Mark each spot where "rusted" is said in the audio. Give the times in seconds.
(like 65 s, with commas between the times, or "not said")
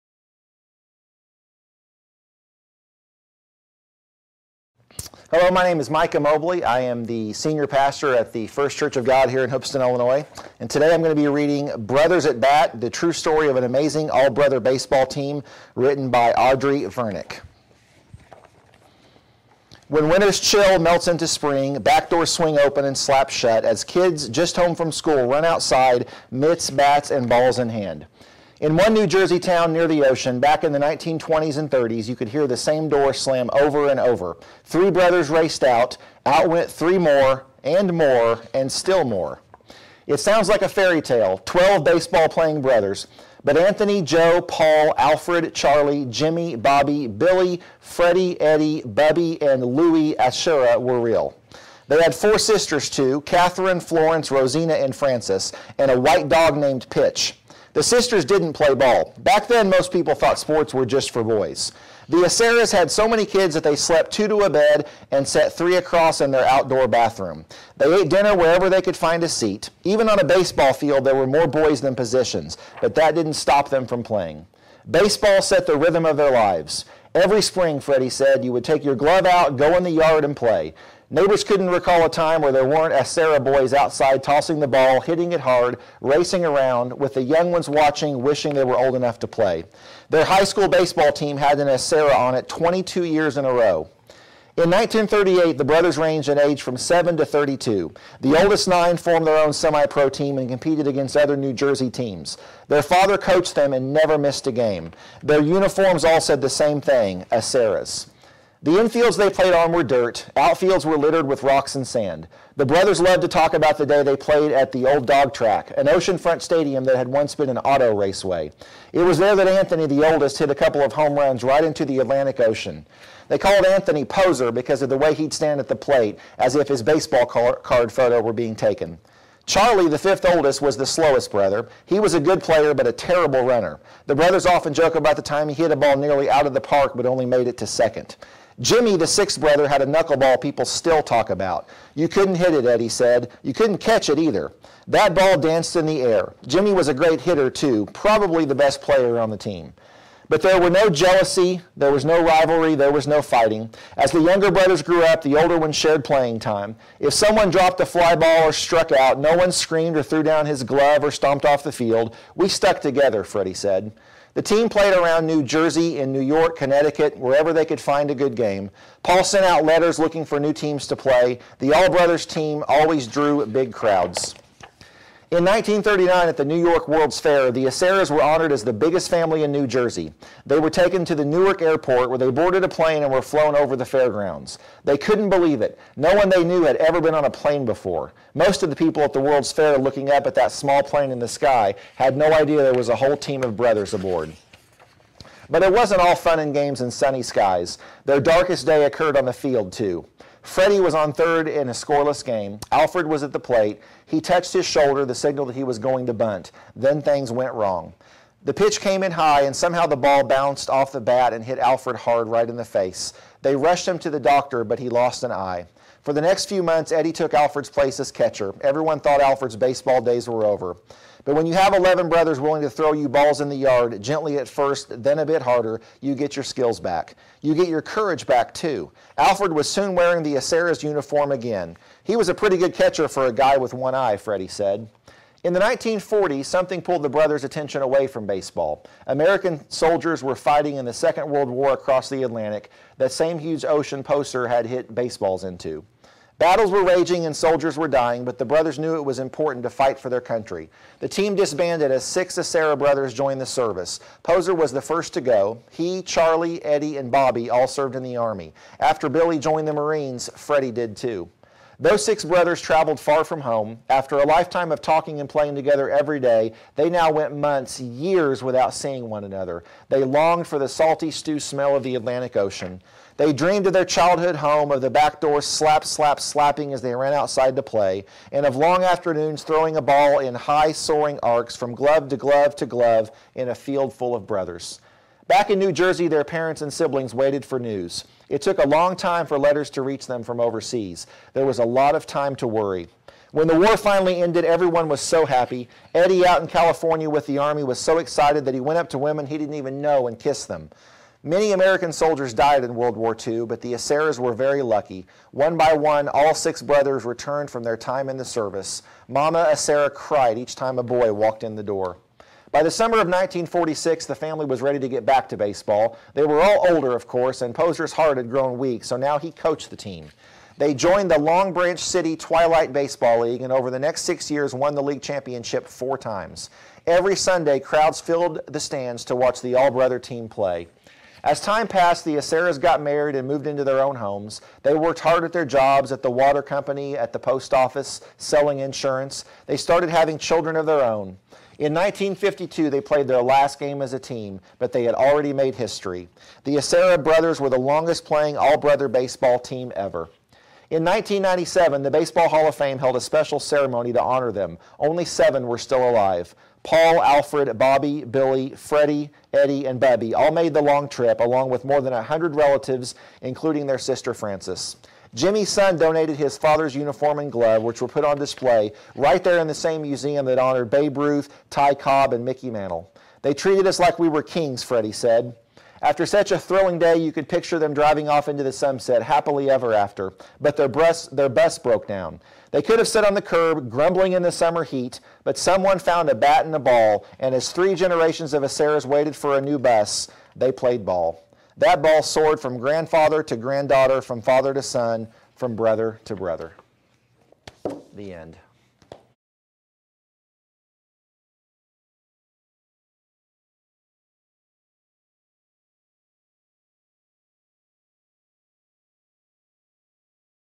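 not said.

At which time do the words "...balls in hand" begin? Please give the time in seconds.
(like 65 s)
27 s.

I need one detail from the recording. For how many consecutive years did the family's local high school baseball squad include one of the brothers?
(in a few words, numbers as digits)
22.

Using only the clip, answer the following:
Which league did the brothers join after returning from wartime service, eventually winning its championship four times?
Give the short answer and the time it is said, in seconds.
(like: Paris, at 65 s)
Long Branch City Twilight Baseball League, at 321 s.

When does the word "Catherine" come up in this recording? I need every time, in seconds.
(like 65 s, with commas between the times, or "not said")
53 s.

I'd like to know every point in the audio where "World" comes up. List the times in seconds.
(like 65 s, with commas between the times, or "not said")
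176 s, 189 s, 241 s, 302 s.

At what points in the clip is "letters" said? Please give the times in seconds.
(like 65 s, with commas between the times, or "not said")
169 s, 289 s.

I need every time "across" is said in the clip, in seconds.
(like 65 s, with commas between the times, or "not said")
65 s, 241 s.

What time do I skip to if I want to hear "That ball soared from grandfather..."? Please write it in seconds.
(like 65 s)
391 s.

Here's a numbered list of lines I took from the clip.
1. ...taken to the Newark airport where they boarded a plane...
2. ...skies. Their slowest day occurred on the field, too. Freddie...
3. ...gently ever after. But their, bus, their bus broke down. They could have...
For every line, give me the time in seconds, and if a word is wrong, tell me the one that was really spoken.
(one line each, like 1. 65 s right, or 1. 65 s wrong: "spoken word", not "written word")
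1. 180 s right
2. 197 s wrong: "darkest", not "slowest"
3. 379 s wrong: "happily", not "gently".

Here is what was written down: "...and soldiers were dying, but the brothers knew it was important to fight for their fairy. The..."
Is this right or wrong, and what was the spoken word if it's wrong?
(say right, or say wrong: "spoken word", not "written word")
wrong: "country", not "fairy".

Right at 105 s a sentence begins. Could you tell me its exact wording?
Their uniforms all said the same thing Acerras.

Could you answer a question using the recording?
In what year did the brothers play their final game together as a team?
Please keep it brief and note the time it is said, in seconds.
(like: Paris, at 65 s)
1952, at 341 s.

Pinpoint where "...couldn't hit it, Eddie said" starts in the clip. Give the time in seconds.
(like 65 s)
142 s.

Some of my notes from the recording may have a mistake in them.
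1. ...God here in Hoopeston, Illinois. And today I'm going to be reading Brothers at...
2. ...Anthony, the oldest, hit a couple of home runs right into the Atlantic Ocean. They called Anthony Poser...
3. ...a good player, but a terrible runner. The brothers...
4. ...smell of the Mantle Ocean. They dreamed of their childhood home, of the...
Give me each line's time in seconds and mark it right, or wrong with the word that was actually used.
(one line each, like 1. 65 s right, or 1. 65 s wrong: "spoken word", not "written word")
1. 9 s right
2. 119 s right
3. 132 s right
4. 271 s wrong: "Atlantic", not "Mantle".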